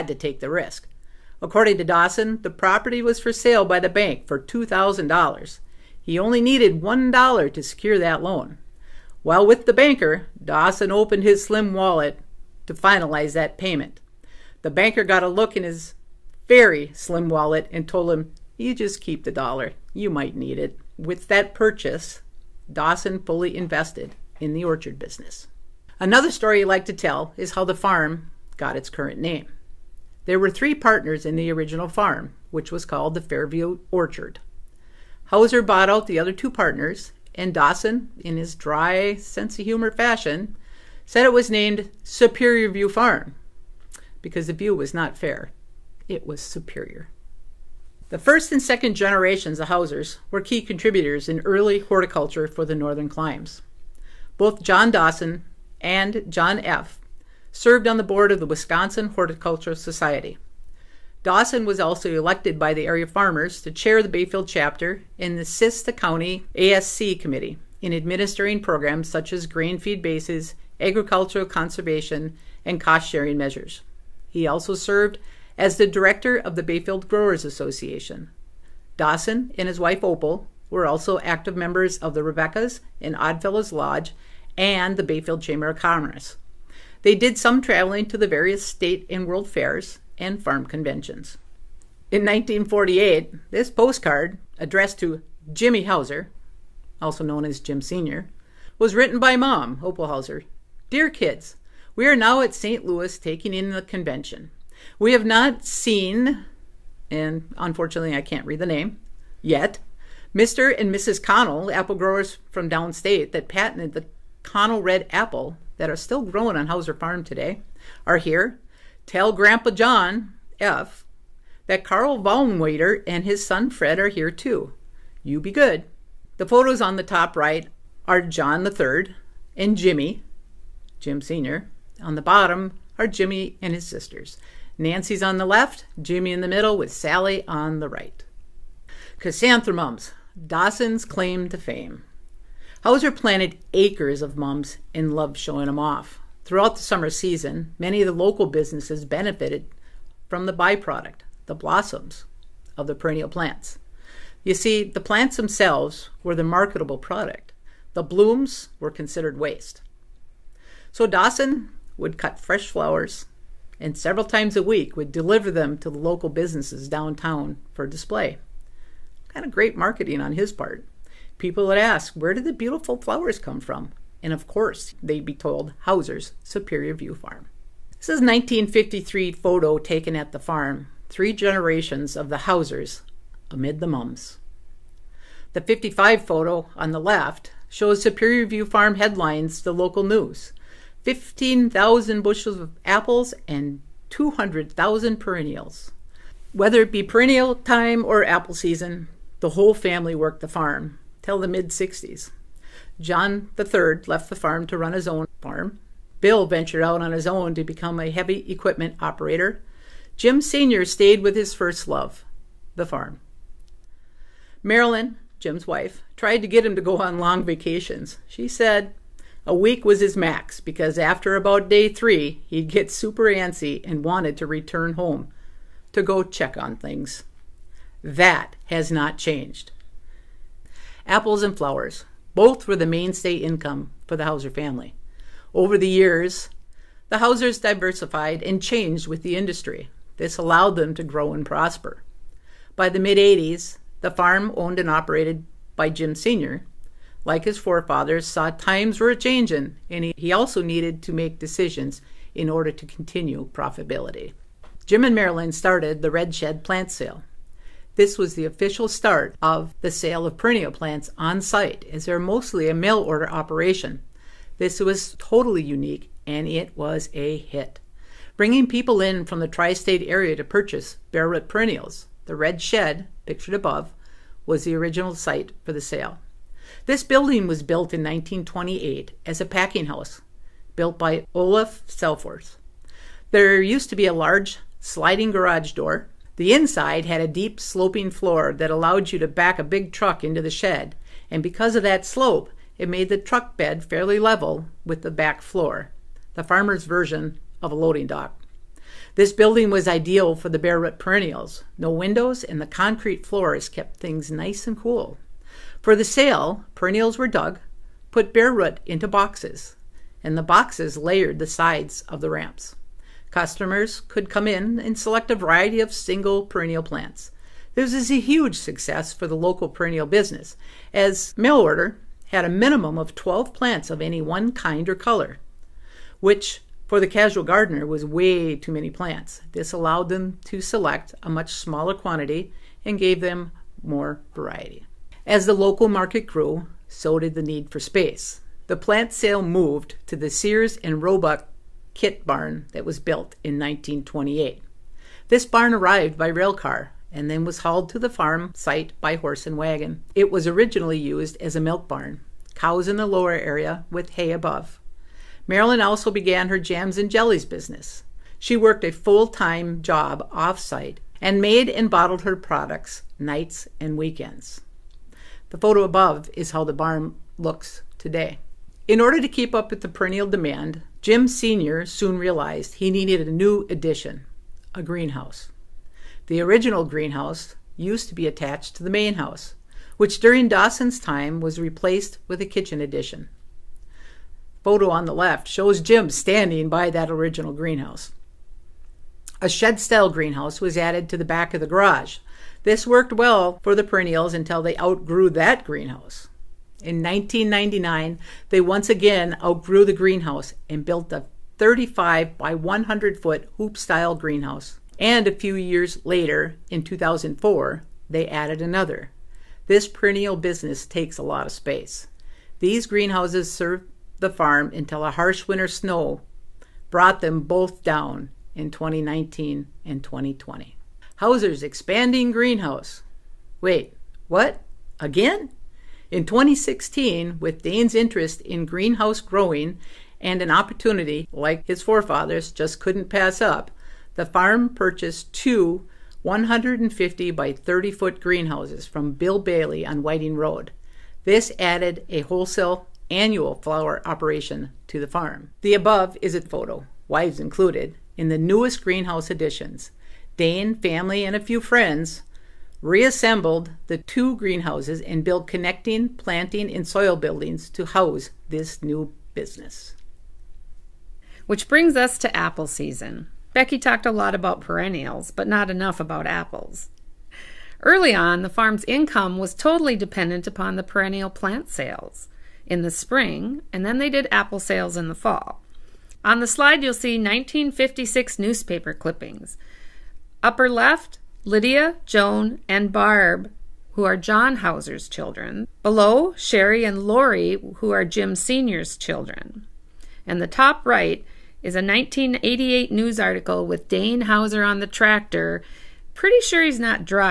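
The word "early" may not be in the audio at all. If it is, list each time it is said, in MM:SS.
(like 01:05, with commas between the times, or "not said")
00:51, 07:47.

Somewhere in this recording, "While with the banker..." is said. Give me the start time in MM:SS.
00:09.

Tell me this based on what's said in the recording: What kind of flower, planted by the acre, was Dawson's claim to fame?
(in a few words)
Chrysanthemums.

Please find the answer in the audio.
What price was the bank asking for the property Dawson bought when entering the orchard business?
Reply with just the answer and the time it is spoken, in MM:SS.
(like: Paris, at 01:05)
$2,000, at 00:04.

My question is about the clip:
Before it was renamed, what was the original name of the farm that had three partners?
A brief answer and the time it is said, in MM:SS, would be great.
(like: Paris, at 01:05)
Fairview Orchard, at 00:33.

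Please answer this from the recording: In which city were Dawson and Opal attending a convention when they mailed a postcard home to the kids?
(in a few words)
St. Louis.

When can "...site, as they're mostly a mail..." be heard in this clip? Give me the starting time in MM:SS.
04:21.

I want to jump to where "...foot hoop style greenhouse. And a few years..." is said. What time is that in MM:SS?
06:43.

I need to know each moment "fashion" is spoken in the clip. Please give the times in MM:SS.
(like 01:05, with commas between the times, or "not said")
00:39.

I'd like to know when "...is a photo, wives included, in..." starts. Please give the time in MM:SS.
07:26.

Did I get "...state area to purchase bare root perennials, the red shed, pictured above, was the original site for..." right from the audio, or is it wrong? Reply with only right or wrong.
right.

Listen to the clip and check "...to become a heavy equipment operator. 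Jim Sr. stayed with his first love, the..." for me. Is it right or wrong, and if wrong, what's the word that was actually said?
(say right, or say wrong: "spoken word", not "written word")
right.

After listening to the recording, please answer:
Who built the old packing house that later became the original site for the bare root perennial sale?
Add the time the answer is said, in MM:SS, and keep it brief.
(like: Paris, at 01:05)
Olaf Selforth, at 04:41.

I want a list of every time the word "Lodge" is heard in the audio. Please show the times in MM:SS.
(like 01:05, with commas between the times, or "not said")
01:23.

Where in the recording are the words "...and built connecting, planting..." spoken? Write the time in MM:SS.
07:35.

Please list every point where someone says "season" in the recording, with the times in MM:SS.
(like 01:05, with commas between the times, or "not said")
02:27, 03:18, 07:42.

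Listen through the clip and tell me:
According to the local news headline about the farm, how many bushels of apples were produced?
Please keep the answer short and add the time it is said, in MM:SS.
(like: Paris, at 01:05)
15,000, at 03:11.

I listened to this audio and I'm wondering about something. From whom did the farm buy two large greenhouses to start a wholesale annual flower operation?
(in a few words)
Bill Bailey.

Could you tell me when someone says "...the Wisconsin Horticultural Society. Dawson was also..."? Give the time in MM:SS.
00:58.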